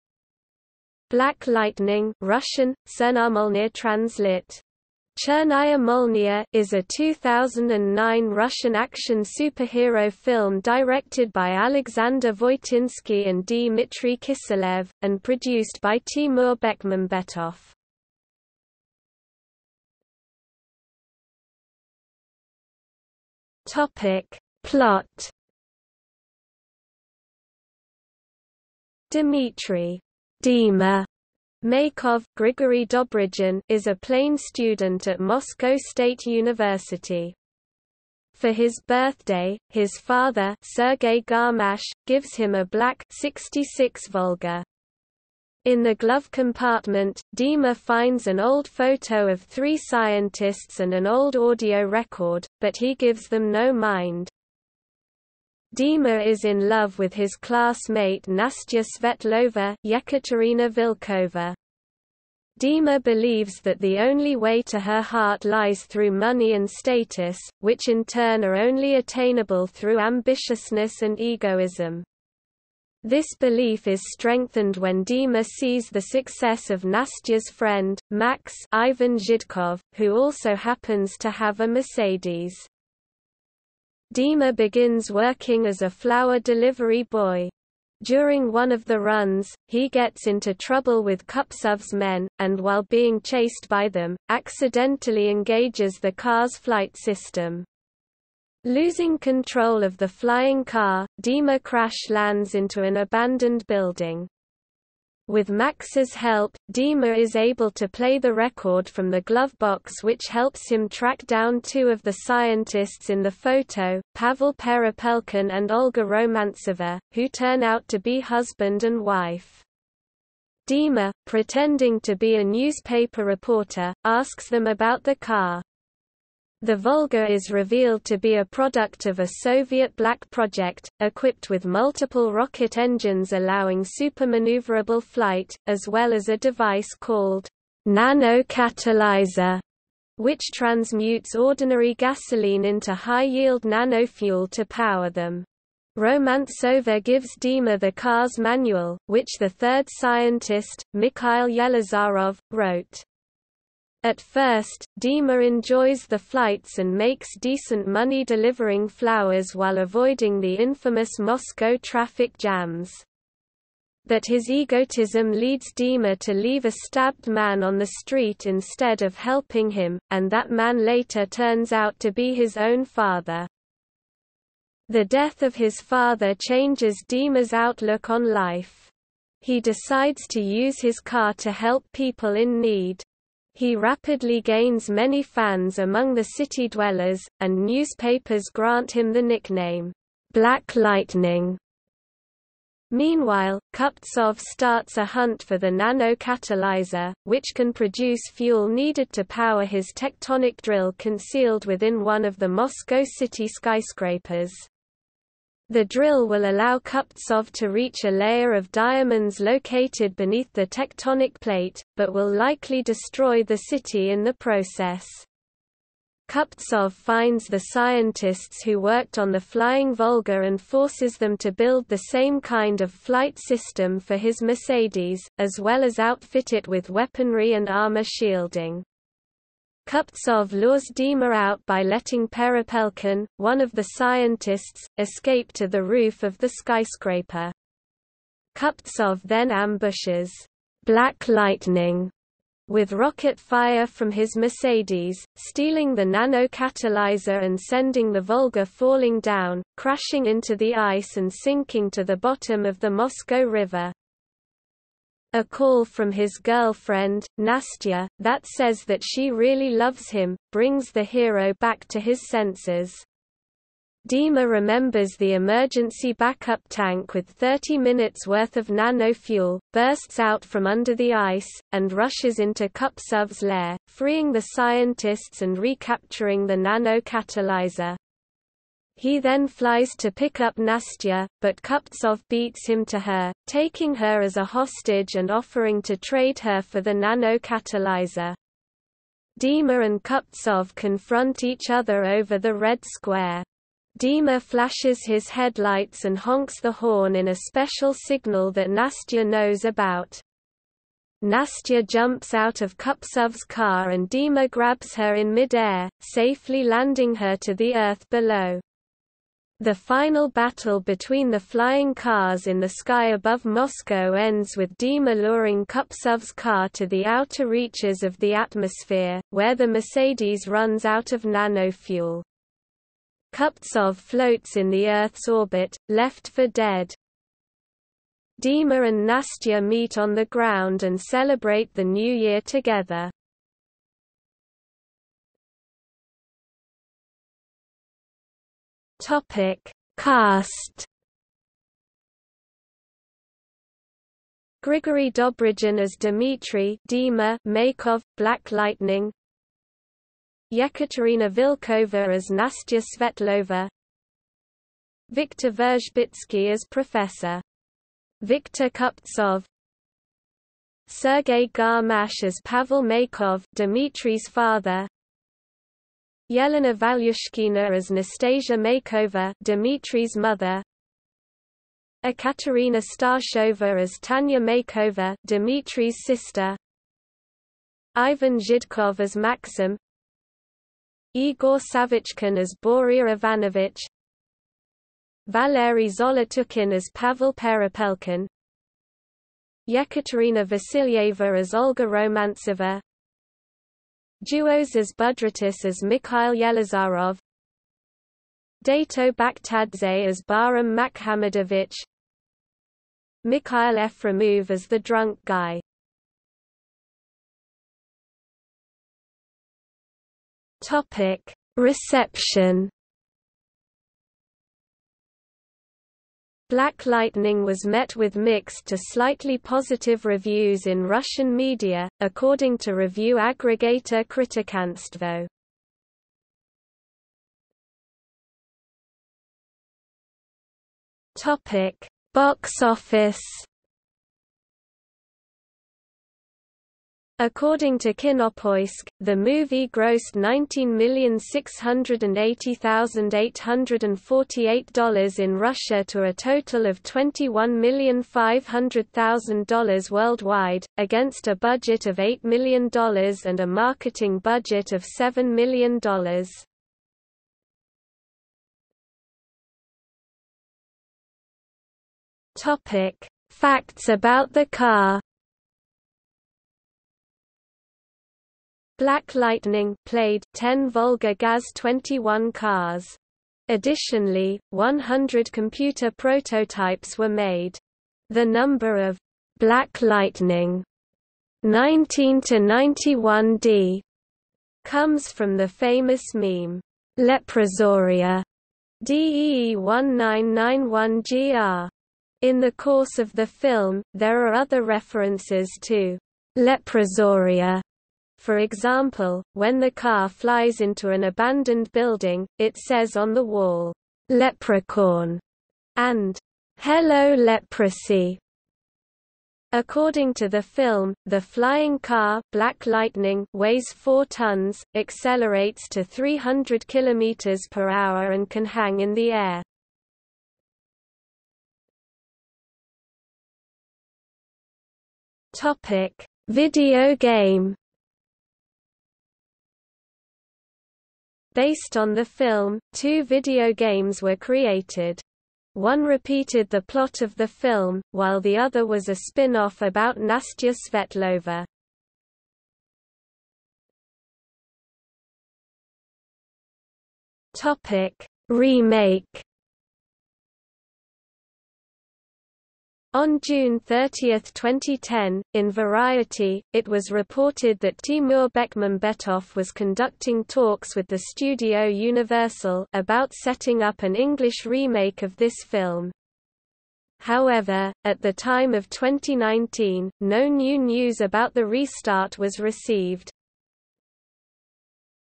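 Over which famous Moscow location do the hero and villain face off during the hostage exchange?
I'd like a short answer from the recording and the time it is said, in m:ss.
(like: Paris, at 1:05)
Red Square, at 4:52.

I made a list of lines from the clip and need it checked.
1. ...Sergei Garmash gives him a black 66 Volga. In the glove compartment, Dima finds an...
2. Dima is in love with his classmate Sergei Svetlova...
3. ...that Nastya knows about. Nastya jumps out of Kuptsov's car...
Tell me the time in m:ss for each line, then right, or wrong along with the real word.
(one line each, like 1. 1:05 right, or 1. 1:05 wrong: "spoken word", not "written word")
1. 0:40 right
2. 0:55 wrong: "Nastya", not "Sergei"
3. 4:58 right.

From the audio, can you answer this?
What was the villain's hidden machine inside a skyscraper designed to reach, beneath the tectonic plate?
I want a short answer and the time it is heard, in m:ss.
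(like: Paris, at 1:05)
A layer of diamonds, at 3:28.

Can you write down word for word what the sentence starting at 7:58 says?
The number of Black Lightning 19 91D comes from the famous meme Leprosoria DEE 1991GR.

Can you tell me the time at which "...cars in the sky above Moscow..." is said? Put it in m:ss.
5:11.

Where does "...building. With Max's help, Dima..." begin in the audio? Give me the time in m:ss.
1:43.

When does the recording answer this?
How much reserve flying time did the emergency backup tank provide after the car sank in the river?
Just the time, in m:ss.
4:27.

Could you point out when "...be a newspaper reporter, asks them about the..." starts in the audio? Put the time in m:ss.
2:02.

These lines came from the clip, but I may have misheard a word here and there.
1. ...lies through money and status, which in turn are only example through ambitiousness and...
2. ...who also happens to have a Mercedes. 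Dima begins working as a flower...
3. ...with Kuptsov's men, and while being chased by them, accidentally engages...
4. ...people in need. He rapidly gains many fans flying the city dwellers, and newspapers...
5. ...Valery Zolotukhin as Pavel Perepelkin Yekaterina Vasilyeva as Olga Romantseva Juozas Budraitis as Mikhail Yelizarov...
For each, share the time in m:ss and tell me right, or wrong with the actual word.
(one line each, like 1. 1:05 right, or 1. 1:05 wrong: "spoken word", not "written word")
1. 1:05 wrong: "attainable", not "example"
2. 1:19 right
3. 1:31 right
4. 3:01 wrong: "among", not "flying"
5. 6:25 right.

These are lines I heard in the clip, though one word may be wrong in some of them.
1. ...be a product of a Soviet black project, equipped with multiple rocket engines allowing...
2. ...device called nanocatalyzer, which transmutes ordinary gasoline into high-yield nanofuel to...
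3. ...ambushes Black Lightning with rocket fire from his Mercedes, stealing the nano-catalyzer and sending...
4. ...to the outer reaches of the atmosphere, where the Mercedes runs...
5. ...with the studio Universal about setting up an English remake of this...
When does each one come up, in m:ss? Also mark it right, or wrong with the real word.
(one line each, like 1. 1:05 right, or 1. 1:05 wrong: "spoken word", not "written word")
1. 2:08 right
2. 2:16 right
3. 3:59 right
4. 5:16 right
5. 9:20 right.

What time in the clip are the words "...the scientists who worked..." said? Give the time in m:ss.
3:37.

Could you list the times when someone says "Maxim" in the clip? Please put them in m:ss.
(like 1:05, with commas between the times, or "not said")
6:19.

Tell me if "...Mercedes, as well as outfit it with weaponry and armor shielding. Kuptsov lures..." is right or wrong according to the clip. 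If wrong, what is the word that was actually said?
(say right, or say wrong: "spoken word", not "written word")
right.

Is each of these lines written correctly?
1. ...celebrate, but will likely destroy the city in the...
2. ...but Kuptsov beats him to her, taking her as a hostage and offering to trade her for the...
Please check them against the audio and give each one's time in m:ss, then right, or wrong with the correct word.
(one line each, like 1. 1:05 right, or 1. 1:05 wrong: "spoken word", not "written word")
1. 3:31 wrong: "plate", not "celebrate"
2. 4:41 right.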